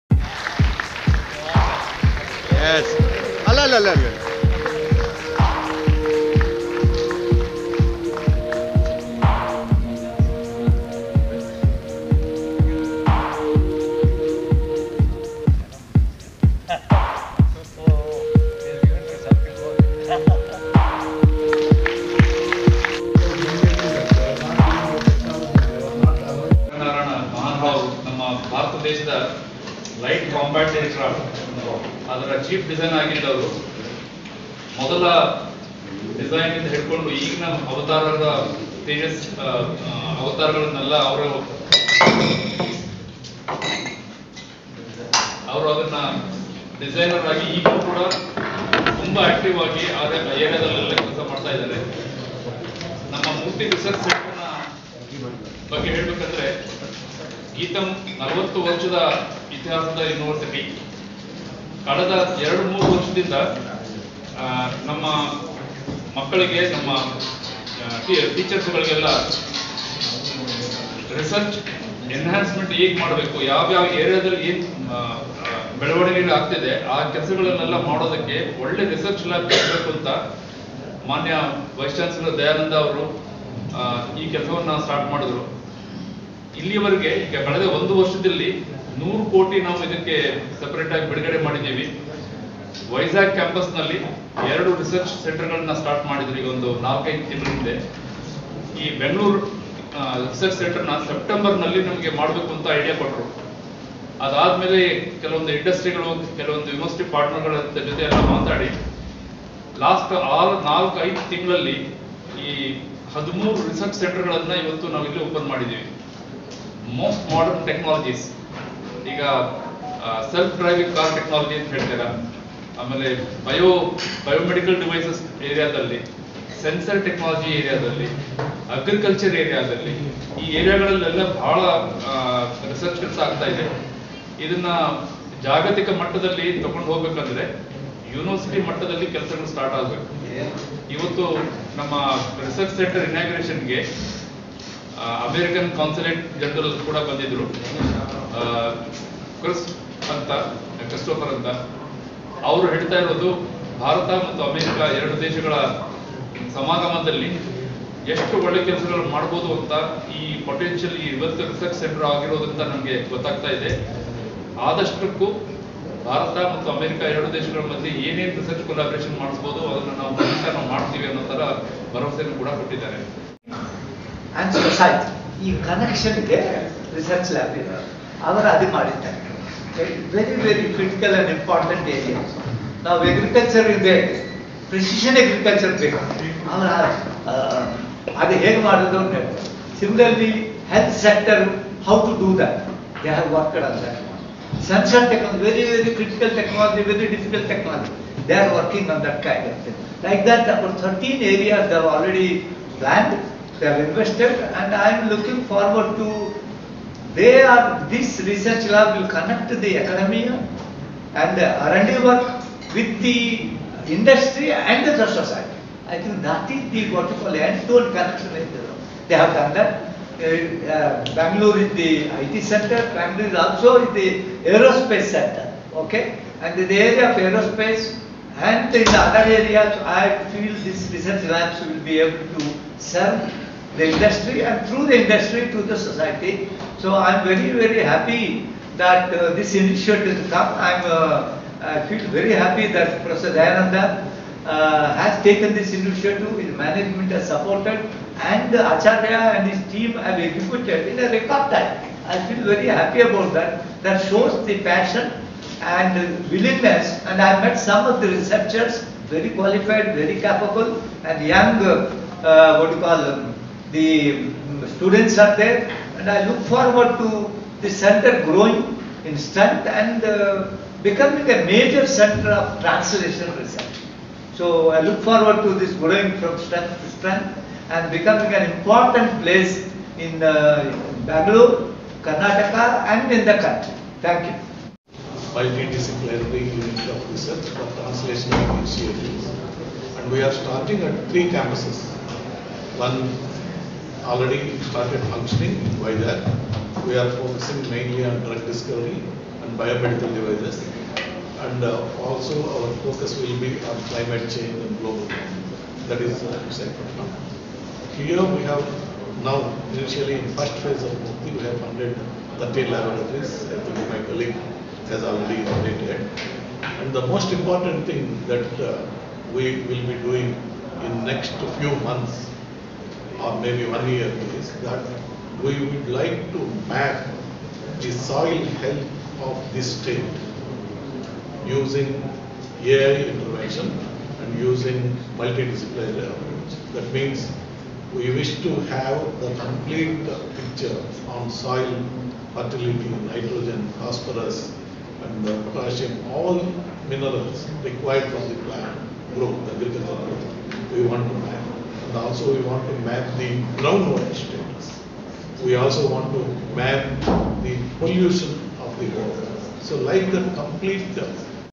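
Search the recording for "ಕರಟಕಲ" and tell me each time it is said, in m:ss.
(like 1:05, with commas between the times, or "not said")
3:00, 3:15.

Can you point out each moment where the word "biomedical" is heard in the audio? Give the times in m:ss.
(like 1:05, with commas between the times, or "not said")
4:59.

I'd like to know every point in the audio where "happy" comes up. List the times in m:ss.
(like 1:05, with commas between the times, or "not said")
3:57, 4:02, 4:12.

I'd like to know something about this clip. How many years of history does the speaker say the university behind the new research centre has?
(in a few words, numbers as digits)
40 years.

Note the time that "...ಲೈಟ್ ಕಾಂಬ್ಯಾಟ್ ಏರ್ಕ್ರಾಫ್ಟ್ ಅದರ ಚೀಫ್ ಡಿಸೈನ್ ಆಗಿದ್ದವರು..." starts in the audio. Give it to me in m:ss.
0:30.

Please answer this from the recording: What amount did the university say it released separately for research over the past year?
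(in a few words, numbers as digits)
100 crore.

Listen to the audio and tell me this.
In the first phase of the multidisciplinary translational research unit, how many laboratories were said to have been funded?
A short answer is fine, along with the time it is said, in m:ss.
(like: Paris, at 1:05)
30, at 5:12.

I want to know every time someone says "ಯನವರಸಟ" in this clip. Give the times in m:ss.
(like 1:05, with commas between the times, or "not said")
1:00, 1:46, 2:18.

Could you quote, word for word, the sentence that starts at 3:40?
Uh, uh Bangalore is the IT center, Bangalore is also the aerospace center, okay?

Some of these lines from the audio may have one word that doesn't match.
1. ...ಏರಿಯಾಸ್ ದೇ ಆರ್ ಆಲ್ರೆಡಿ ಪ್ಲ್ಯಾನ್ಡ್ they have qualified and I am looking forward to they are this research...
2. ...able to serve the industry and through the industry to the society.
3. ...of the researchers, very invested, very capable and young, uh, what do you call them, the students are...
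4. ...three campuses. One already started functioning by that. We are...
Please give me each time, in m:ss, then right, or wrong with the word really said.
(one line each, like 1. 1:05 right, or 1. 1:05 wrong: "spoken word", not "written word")
1. 3:21 wrong: "invested", not "qualified"
2. 3:51 right
3. 4:17 wrong: "qualified", not "invested"
4. 4:51 right.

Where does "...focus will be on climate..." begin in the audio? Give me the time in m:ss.
5:02.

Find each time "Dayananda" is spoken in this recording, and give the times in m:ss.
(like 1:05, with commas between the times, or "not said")
4:03.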